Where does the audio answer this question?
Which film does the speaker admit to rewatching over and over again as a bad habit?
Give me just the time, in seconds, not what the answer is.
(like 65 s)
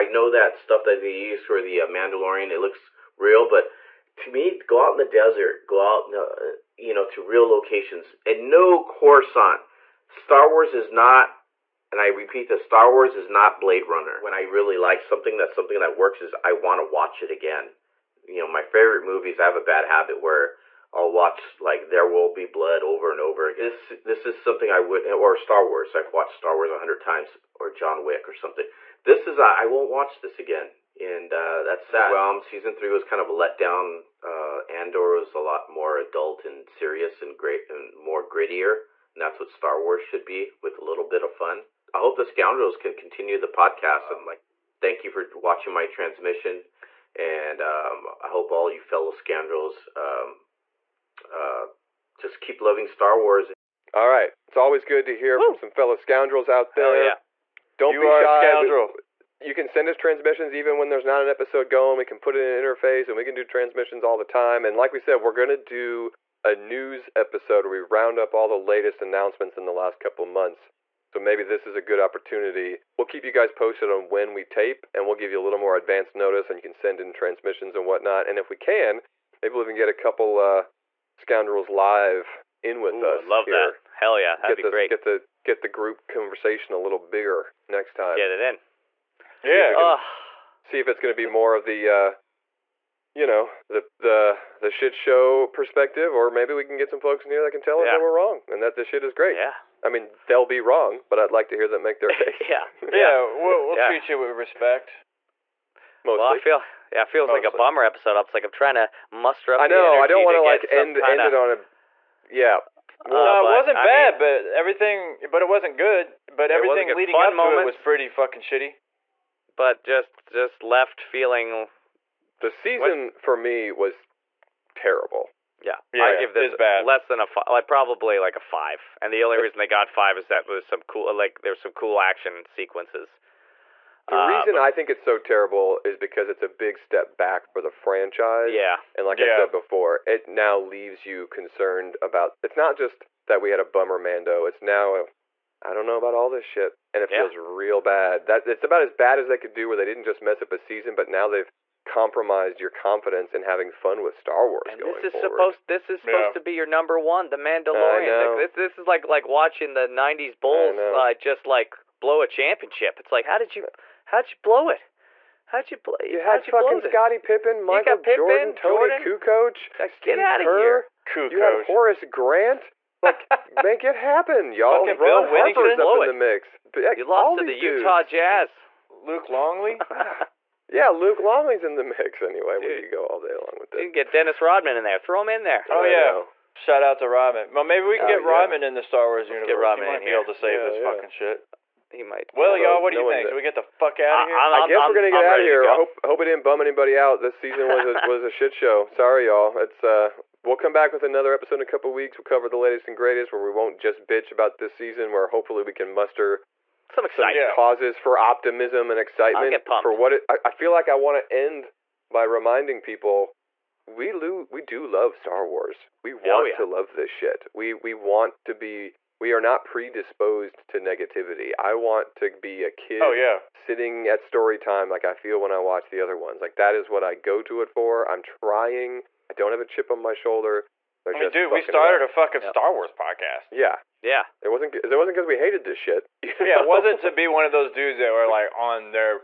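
21 s.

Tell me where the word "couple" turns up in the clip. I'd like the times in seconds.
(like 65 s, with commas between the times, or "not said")
69 s, 79 s, 201 s.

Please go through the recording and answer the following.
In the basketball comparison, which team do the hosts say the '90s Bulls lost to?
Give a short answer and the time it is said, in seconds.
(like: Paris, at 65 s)
Utah Jazz, at 177 s.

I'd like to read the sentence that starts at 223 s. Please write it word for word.
sitting at story time like I feel when I watch the other ones.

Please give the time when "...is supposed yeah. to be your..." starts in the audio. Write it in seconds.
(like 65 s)
155 s.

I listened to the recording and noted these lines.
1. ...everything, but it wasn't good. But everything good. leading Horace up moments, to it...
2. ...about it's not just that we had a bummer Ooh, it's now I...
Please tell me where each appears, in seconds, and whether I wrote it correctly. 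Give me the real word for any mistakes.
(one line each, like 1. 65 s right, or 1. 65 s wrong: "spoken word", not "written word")
1. 114 s wrong: "Fun", not "Horace"
2. 142 s wrong: "Mando", not "Ooh".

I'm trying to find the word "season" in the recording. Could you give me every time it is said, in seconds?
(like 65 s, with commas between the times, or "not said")
32 s, 122 s, 150 s, 197 s, 204 s.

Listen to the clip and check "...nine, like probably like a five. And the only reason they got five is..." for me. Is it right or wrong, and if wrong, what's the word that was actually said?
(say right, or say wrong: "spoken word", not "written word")
wrong: "five", not "nine".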